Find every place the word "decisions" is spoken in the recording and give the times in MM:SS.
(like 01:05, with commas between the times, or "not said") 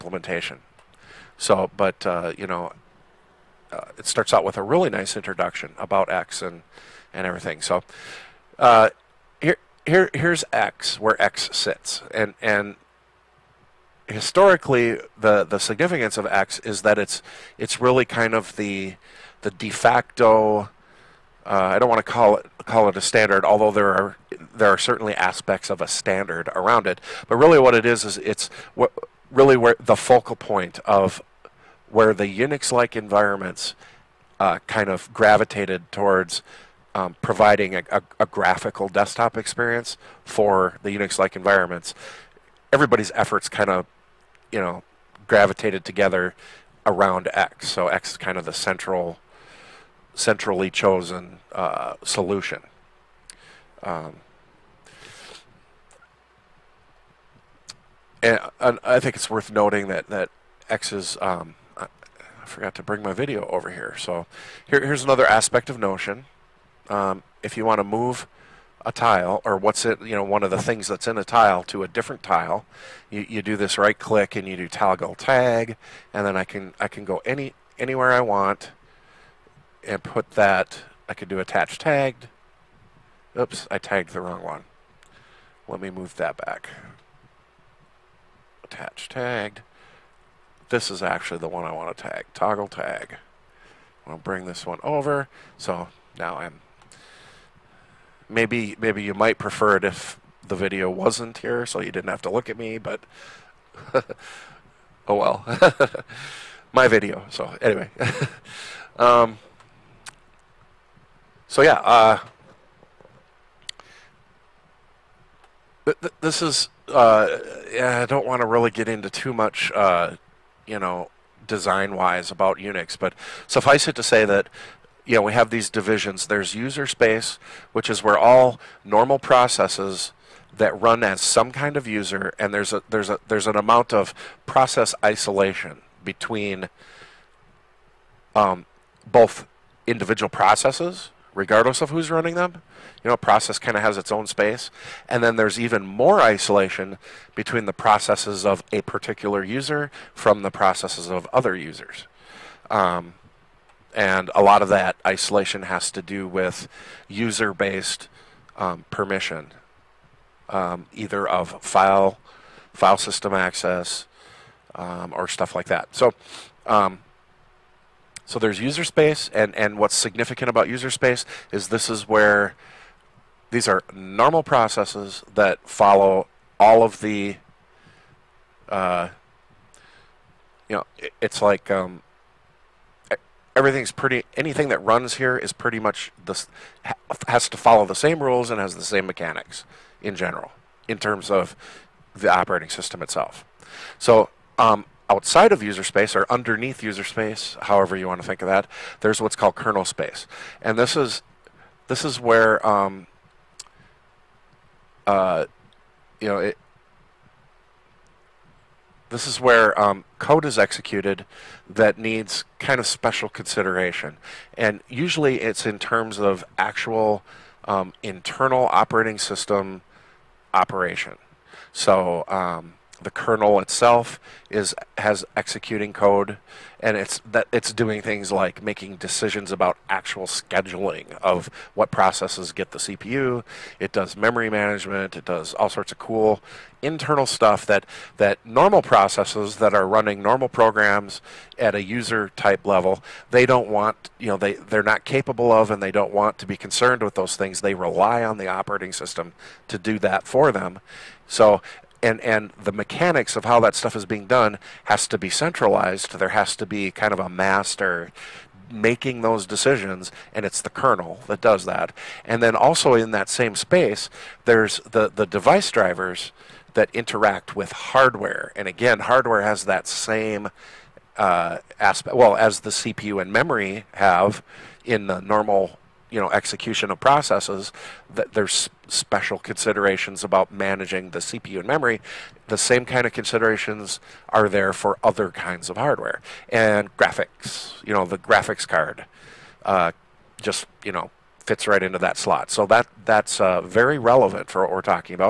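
03:48, 04:19.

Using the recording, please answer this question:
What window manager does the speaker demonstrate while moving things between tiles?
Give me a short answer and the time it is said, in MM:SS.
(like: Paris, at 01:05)
Notion, at 01:05.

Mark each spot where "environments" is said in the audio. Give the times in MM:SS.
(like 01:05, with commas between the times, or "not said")
00:32, 00:41.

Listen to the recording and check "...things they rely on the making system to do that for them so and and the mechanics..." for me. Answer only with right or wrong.
wrong.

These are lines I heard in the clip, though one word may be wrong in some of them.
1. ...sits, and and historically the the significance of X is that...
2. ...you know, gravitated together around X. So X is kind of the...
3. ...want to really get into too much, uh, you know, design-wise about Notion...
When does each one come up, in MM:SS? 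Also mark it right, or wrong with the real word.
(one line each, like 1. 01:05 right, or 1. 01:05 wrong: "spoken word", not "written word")
1. 00:11 right
2. 00:44 right
3. 01:58 wrong: "Unix", not "Notion".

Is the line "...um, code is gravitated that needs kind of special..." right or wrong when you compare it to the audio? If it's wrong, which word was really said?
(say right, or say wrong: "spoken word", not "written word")
wrong: "executed", not "gravitated".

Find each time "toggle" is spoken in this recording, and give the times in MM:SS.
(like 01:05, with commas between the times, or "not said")
01:14, 01:32.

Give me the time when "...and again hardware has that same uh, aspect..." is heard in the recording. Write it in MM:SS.
04:28.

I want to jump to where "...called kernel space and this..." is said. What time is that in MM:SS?
03:19.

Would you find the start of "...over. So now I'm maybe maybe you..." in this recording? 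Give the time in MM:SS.
01:34.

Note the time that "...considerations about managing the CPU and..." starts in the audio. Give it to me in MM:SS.
04:39.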